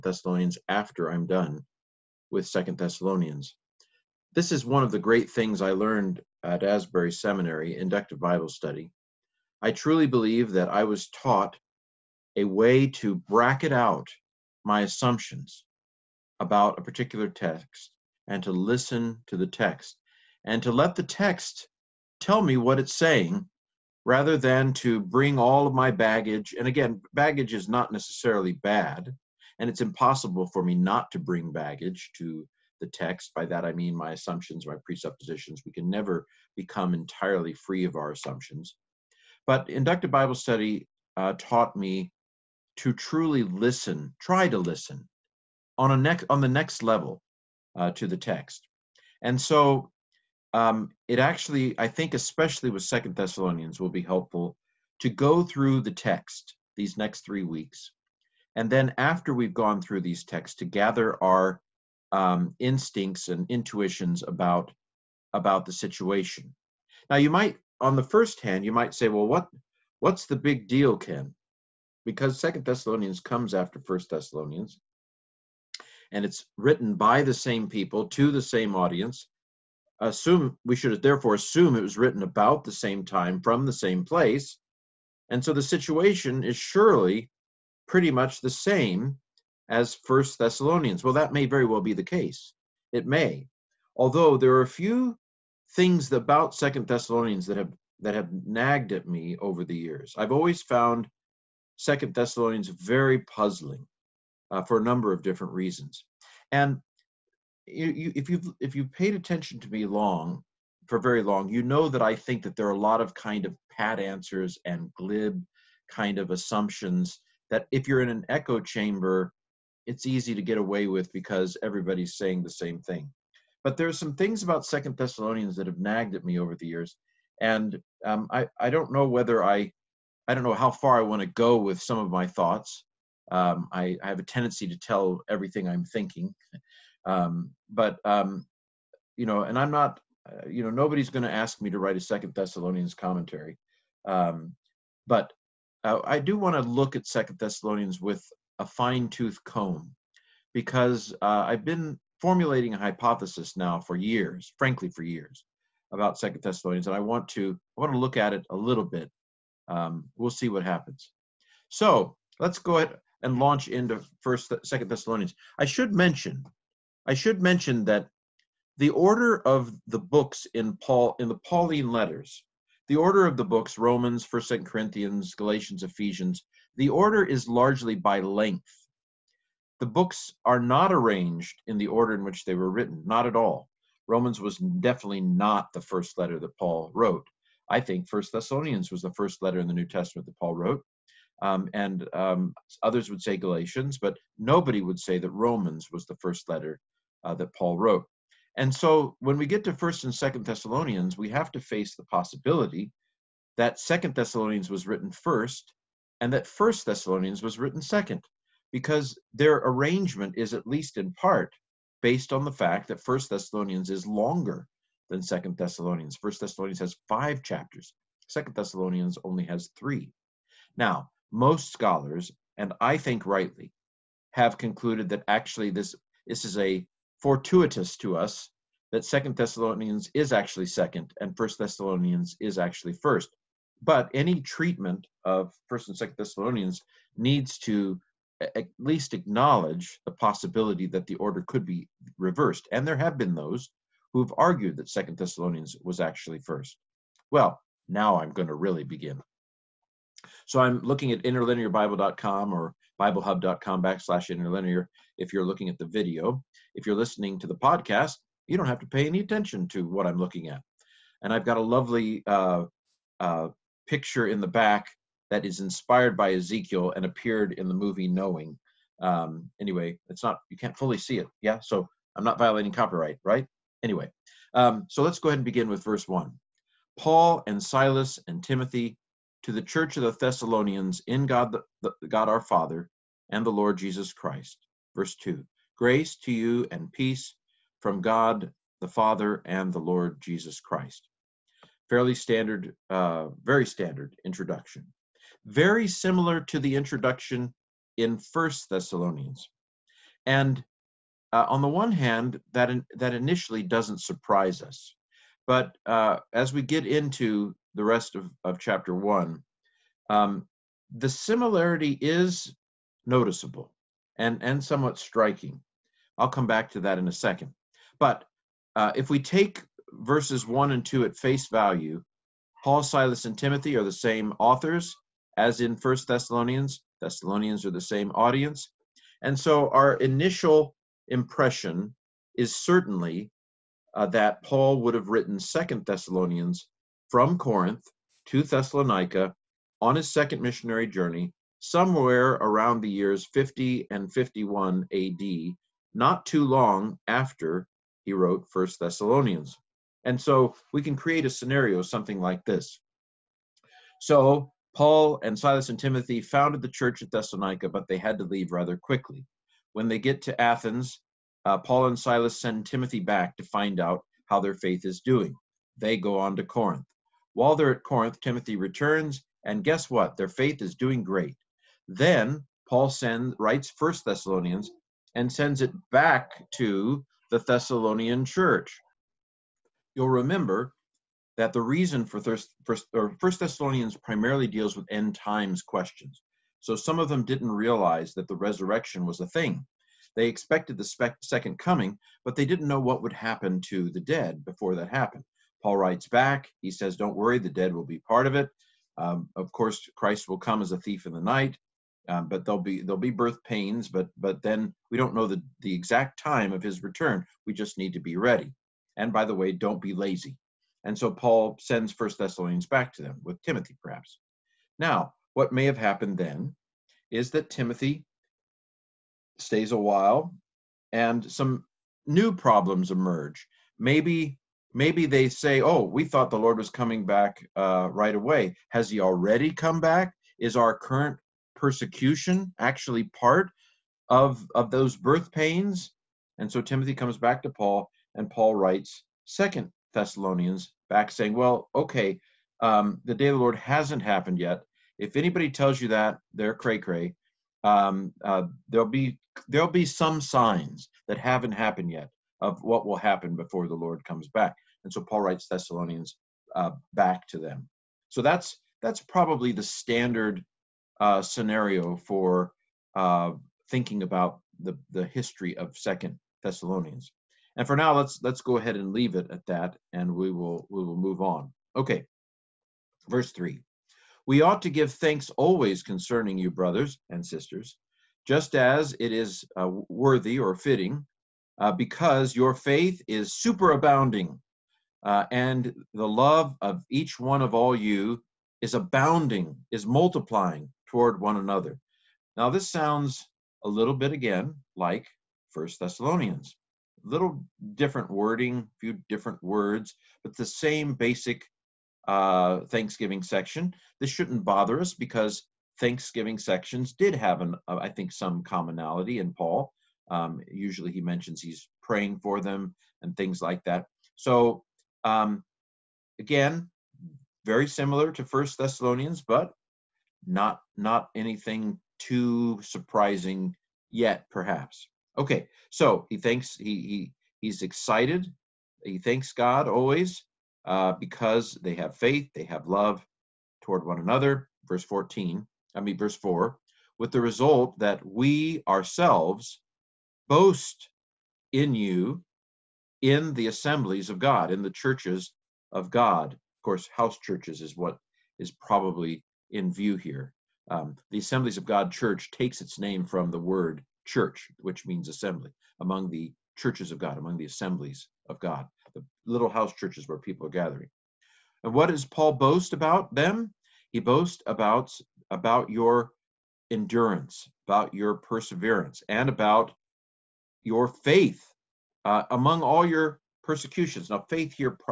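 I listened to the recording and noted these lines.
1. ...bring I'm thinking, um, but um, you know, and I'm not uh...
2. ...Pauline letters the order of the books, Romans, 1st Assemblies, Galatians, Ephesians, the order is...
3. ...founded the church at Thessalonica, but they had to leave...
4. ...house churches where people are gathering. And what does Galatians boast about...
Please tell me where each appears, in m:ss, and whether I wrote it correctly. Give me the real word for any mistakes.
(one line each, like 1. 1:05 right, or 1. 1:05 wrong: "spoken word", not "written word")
1. 2:15 wrong: "everything", not "bring"
2. 2:51 wrong: "Corinthians", not "Assemblies"
3. 5:56 right
4. 9:19 wrong: "Paul", not "Galatians".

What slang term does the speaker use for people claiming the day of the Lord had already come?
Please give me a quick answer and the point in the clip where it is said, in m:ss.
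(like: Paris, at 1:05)
cray cray, at 7:26.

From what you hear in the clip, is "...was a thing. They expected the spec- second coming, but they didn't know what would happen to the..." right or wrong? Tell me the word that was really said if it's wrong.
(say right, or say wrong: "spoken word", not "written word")
right.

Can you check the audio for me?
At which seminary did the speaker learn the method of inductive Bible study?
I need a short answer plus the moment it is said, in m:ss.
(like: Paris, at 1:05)
Asbury Seminary, at 0:06.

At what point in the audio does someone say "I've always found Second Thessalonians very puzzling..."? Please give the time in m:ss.
1:40.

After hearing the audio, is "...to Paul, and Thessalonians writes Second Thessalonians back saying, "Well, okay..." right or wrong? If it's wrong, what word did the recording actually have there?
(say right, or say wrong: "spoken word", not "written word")
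wrong: "Paul", not "Thessalonians".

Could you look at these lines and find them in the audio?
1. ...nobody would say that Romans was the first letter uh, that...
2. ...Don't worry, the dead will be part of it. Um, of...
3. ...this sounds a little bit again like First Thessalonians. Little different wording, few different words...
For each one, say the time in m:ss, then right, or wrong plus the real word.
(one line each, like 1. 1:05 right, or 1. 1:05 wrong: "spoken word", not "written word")
1. 3:14 right
2. 6:36 right
3. 8:12 right.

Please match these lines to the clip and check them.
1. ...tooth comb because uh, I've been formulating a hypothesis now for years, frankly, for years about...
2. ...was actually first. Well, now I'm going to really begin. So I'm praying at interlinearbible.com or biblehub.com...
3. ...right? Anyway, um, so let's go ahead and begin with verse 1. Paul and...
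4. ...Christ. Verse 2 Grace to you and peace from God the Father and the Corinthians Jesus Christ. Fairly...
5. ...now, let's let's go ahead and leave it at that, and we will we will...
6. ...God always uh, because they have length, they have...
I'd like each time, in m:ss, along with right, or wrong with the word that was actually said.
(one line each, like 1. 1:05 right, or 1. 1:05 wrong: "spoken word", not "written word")
1. 2:29 right
2. 4:05 wrong: "looking", not "praying"
3. 4:33 right
4. 4:44 wrong: "Lord", not "Corinthians"
5. 7:47 right
6. 8:49 wrong: "faith", not "length".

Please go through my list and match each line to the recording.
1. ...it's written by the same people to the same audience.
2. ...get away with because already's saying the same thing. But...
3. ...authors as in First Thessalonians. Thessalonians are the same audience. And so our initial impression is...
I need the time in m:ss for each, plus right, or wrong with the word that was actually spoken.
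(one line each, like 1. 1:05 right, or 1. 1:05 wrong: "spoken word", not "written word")
1. 1:16 right
2. 2:00 wrong: "everybody", not "already"
3. 5:24 right.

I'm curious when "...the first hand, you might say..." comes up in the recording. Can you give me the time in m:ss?
1:07.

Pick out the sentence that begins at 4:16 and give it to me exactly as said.
If you're listening to the podcast, you don't have to pay any attention to what I'm looking at.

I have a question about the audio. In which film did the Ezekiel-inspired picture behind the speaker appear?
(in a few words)
Knowing.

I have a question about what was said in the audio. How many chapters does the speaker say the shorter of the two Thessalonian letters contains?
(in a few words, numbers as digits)
3.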